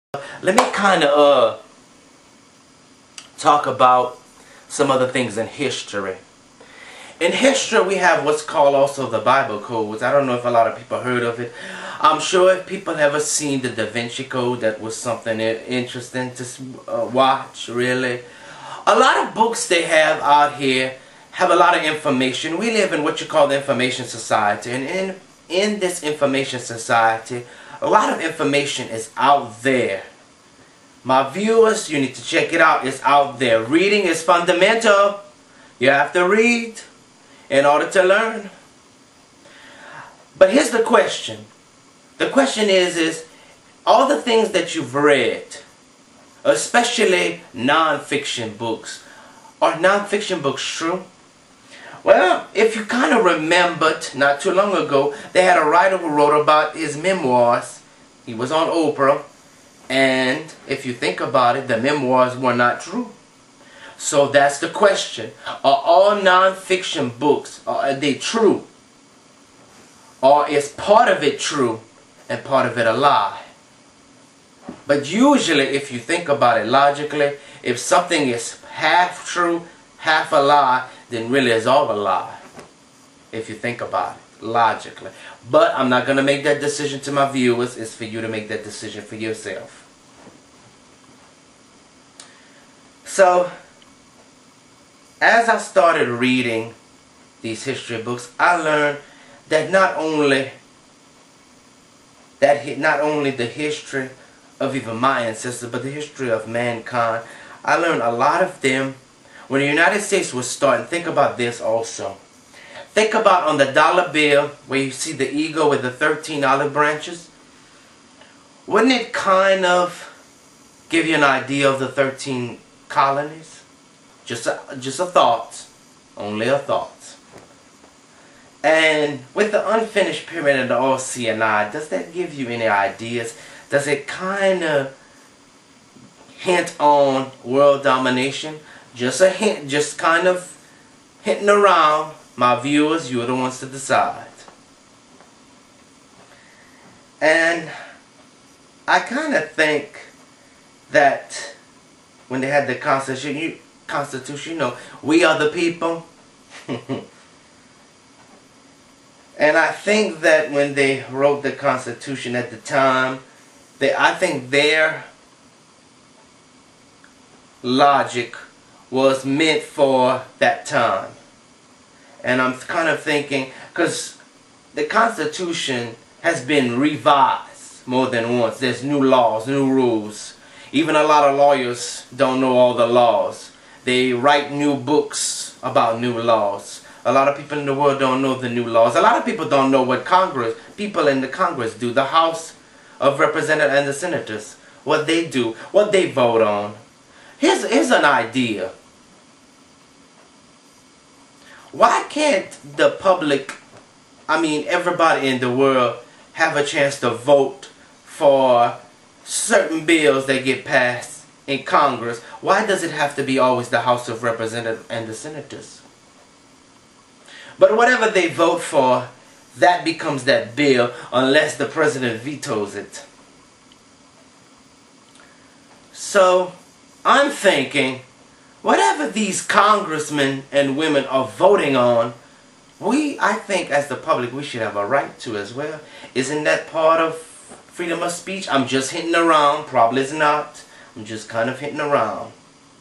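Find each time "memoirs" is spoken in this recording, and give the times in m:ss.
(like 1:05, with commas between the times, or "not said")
0:56, 1:01.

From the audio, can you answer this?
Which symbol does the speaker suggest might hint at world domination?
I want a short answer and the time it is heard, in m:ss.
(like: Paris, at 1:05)
unfinished pyramid, at 2:09.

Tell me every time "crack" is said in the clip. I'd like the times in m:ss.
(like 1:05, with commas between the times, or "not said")
not said.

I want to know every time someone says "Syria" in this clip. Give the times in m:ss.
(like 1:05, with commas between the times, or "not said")
not said.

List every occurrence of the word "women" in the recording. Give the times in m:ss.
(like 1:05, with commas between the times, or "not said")
3:50.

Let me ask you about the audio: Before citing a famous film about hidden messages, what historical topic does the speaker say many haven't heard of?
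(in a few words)
Bible codes.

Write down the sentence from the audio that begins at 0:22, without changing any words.
We live in what you call the information society.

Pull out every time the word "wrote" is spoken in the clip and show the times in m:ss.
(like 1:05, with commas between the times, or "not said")
0:56, 2:41.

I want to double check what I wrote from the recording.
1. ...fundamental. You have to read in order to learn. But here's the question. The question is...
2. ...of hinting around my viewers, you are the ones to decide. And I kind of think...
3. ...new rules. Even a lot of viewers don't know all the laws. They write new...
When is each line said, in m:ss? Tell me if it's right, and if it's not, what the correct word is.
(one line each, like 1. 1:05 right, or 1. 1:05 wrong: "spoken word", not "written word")
1. 0:34 right
2. 2:20 right
3. 2:59 wrong: "lawyers", not "viewers".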